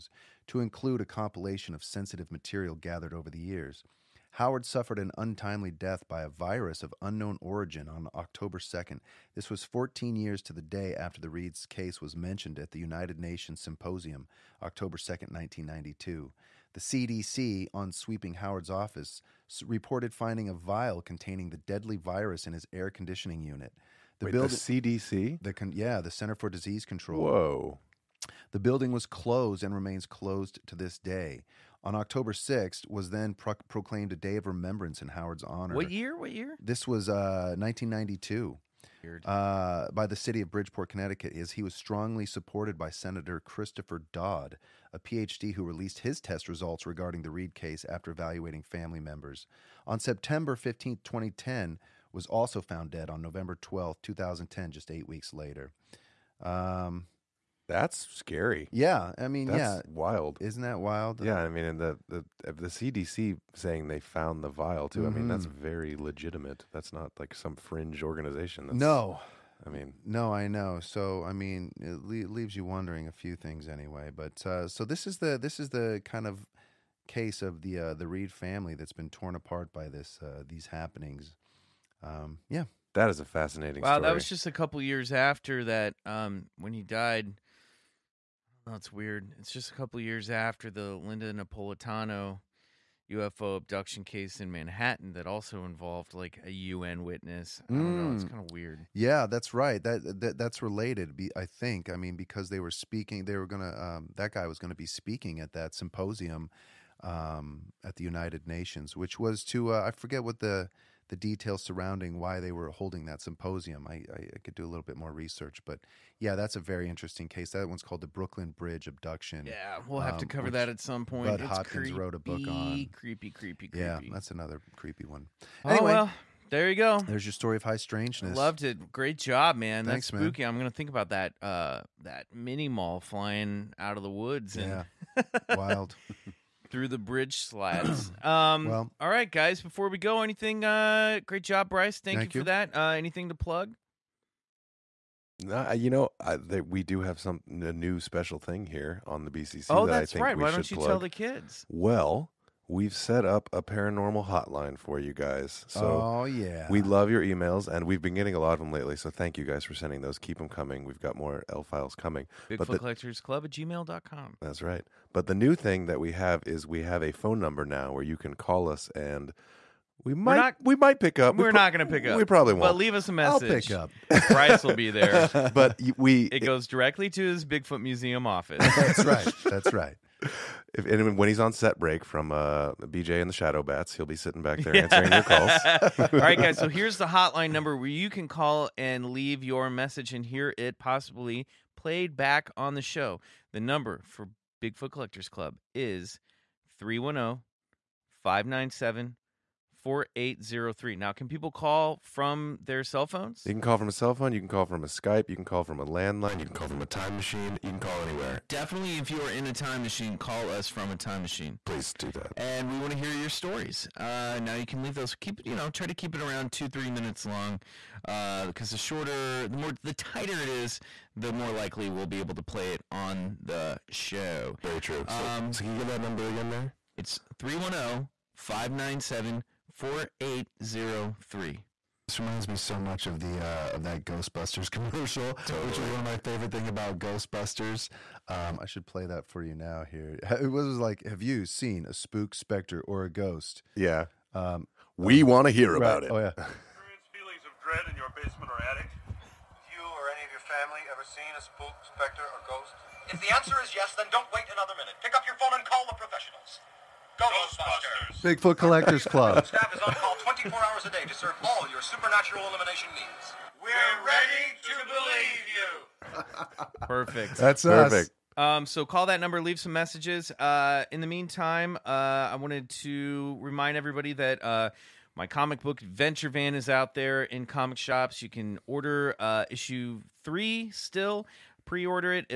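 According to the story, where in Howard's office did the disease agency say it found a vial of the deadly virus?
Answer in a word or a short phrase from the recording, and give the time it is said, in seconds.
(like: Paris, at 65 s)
air conditioning unit, at 22 s.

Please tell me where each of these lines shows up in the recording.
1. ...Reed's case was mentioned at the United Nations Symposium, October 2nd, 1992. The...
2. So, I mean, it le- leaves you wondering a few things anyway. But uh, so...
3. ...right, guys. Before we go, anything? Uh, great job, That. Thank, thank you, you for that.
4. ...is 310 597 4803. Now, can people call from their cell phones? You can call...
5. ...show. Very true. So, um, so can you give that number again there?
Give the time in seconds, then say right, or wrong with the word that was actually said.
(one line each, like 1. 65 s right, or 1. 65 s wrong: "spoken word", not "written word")
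1. 11 s right
2. 70 s right
3. 139 s wrong: "Bryce", not "That"
4. 195 s right
5. 223 s right.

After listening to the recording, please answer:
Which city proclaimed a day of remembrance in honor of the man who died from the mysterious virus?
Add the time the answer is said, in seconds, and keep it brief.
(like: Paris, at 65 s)
Bridgeport, Connecticut, at 40 s.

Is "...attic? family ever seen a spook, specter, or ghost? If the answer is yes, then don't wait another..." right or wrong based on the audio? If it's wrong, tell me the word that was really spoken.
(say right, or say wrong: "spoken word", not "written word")
right.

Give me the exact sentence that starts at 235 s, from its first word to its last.
which was one of my favorite thing about Ghostbusters.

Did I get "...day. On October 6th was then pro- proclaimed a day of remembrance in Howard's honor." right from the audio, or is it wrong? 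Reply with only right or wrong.
right.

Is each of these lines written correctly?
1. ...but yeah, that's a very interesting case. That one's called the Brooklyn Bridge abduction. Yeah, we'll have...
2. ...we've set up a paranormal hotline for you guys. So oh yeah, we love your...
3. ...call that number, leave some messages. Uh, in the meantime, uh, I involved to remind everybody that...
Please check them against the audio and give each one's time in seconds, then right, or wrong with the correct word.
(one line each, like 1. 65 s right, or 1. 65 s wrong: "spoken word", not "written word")
1. 115 s right
2. 152 s right
3. 268 s wrong: "wanted", not "involved".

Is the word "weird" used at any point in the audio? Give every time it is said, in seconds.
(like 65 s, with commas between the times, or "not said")
88 s, 98 s.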